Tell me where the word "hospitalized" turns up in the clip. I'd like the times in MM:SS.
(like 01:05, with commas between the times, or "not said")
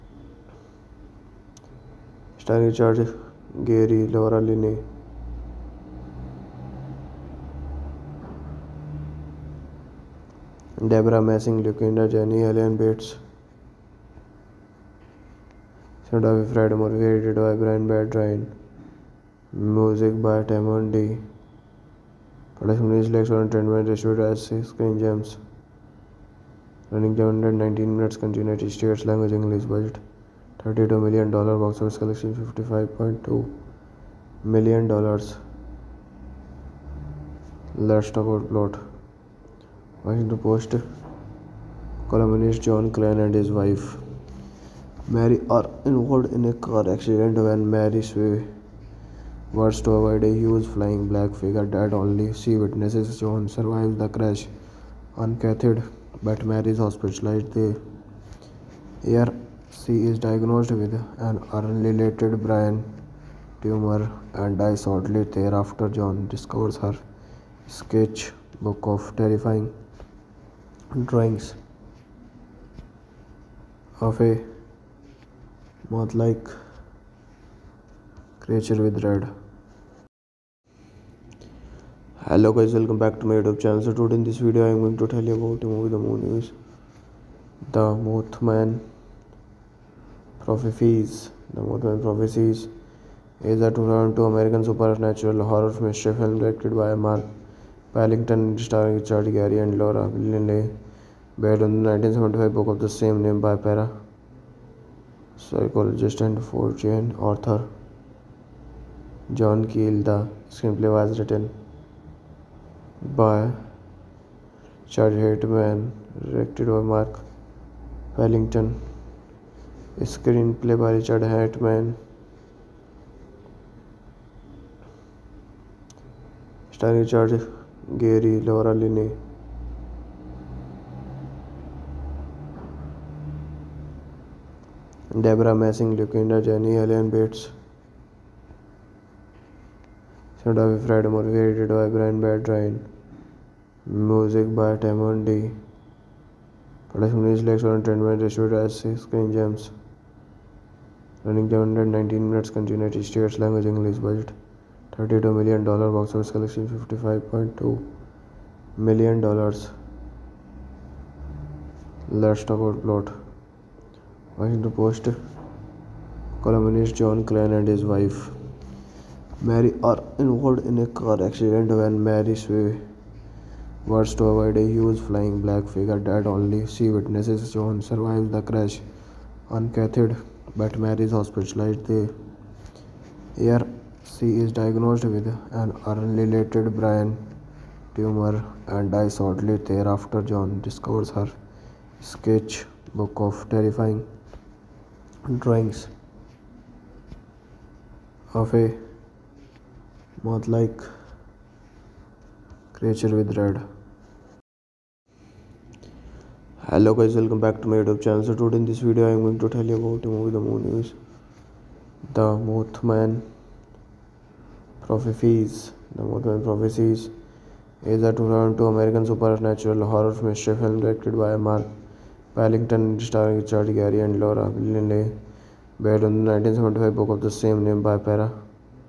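00:56, 03:01.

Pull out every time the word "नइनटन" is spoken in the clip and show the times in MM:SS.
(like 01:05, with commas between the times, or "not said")
00:27.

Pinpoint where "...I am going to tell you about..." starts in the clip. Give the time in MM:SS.
01:24.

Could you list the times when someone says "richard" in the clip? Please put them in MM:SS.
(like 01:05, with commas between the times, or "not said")
01:38, 01:54, 03:43.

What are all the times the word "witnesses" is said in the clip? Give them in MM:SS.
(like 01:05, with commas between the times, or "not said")
00:52, 02:56.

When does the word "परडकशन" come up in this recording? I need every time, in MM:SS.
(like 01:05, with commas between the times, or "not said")
00:22, 02:26.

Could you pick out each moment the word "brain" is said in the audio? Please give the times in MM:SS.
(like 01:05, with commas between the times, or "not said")
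01:02, 03:06.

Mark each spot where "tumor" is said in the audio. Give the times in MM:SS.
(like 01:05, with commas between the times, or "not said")
01:03, 03:07.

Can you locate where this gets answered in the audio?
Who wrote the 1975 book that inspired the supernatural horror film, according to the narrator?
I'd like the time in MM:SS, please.
01:49.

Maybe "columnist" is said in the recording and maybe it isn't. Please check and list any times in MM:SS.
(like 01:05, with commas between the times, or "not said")
00:42, 02:46.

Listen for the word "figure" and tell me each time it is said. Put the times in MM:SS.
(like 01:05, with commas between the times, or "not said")
00:51, 02:55.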